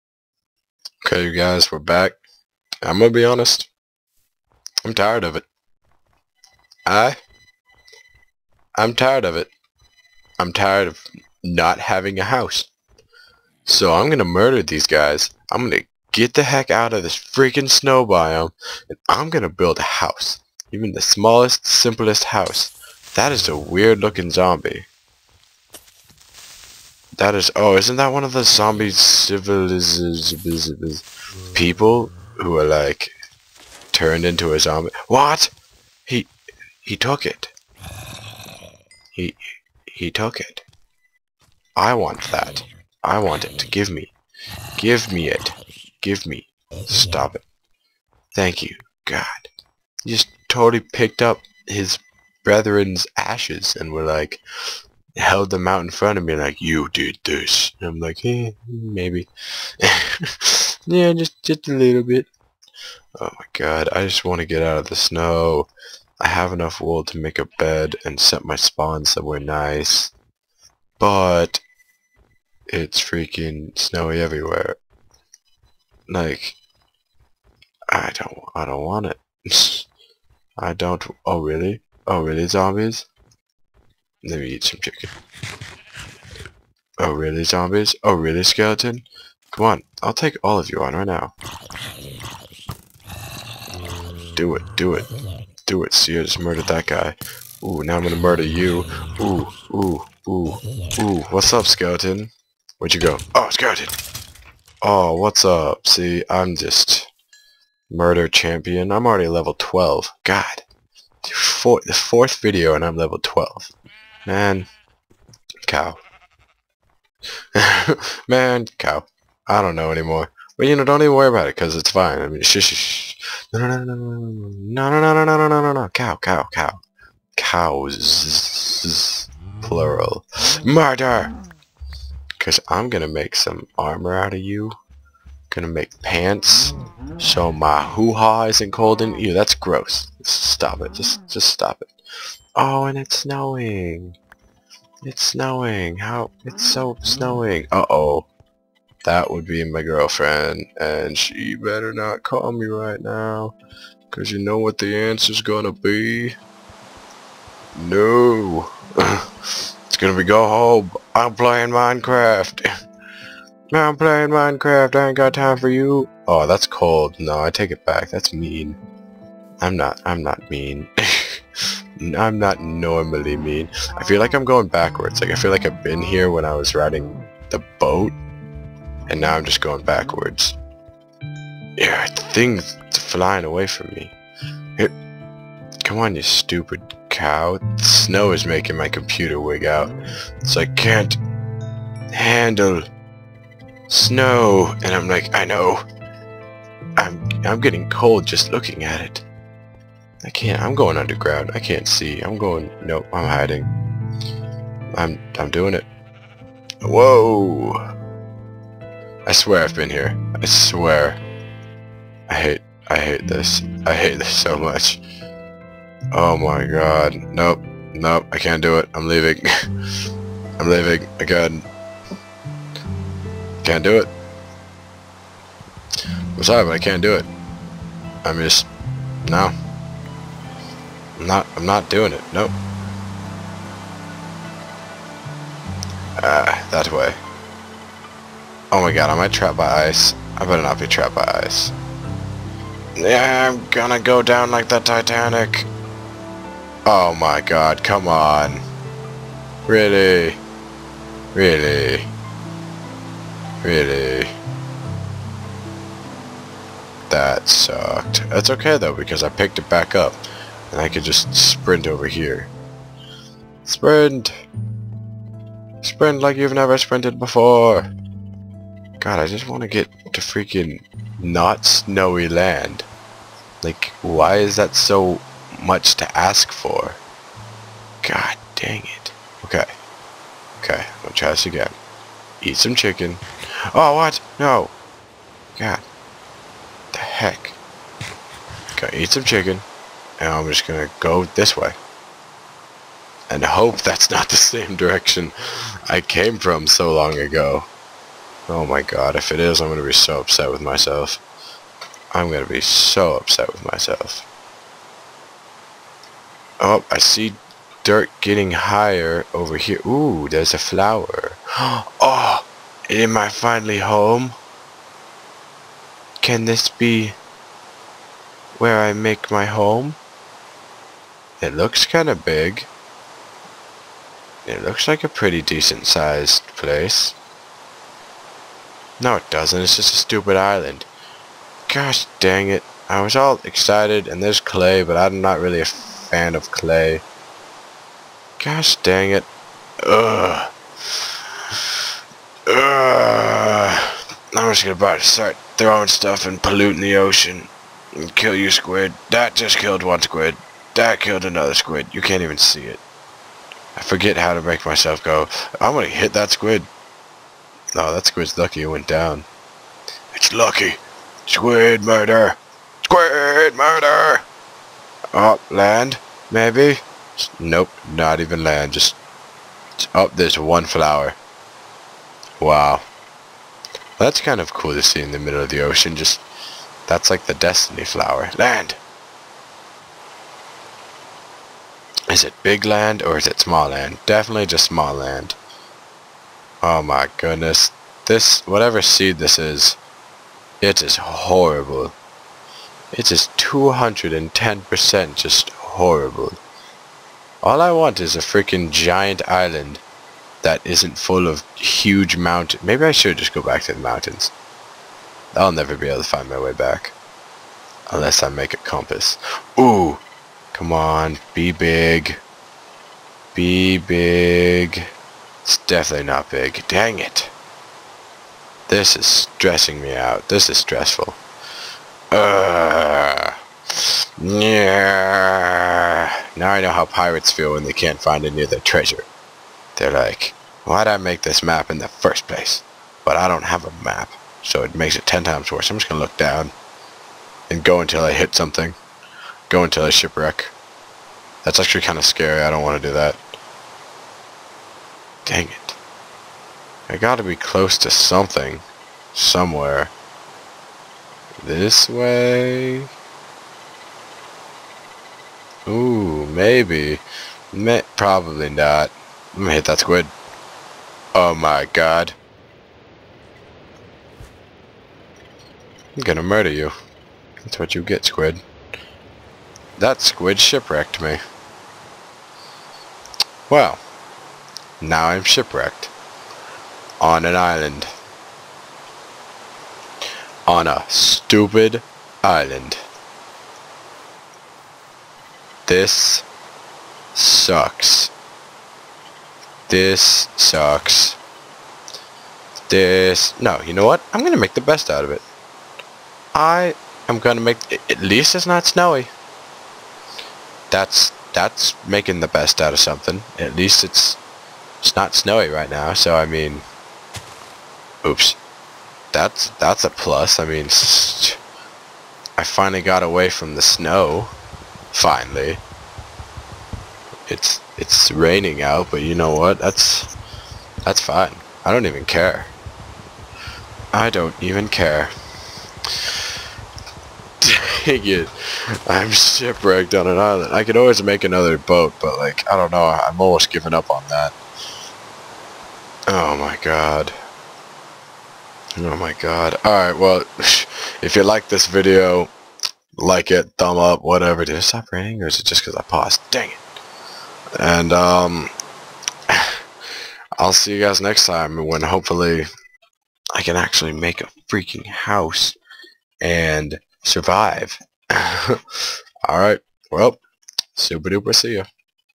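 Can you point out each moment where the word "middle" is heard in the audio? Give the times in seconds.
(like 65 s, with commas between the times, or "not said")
375 s.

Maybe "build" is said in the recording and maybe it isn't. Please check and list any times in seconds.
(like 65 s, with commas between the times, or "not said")
19 s.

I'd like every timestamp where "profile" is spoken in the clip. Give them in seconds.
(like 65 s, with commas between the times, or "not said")
not said.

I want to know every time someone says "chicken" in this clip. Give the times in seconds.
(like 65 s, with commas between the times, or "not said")
84 s, 282 s, 289 s.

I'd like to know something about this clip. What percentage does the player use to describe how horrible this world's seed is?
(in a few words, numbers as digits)
210%.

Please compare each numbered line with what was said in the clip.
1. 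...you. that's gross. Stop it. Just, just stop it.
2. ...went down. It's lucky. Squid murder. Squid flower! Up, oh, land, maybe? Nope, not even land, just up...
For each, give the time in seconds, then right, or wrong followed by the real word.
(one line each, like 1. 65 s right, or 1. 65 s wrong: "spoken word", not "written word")
1. 139 s right
2. 358 s wrong: "murder", not "flower".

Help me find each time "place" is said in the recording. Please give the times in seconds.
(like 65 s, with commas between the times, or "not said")
326 s, 432 s.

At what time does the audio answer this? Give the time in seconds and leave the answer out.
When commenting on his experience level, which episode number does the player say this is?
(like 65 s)
111 s.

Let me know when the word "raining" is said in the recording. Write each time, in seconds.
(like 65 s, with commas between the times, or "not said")
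518 s, 544 s.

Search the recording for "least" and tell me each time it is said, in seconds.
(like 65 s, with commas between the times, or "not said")
498 s, 503 s.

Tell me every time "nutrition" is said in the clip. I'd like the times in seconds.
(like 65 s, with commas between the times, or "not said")
not said.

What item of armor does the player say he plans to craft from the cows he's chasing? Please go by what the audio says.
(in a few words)
pants.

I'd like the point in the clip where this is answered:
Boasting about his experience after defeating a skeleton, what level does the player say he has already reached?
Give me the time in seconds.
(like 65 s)
108 s.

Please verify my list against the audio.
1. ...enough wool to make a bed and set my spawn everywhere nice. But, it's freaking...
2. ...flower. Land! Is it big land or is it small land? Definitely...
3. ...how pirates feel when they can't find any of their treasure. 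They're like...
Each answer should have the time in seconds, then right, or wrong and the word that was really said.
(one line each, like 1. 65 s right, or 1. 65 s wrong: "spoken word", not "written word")
1. 66 s wrong: "somewhere", not "everywhere"
2. 377 s right
3. 426 s right.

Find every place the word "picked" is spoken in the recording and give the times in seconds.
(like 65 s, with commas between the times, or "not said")
50 s, 259 s.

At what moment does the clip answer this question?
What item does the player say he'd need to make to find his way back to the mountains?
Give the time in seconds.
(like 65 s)
407 s.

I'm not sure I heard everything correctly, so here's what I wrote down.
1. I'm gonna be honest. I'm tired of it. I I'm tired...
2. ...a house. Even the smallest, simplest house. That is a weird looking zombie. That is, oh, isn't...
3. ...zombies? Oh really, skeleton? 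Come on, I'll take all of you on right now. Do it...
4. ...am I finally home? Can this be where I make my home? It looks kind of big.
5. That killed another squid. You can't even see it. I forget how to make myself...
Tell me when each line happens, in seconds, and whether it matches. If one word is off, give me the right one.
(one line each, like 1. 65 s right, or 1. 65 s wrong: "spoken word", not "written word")
1. 2 s right
2. 19 s right
3. 87 s right
4. 312 s right
5. 350 s right.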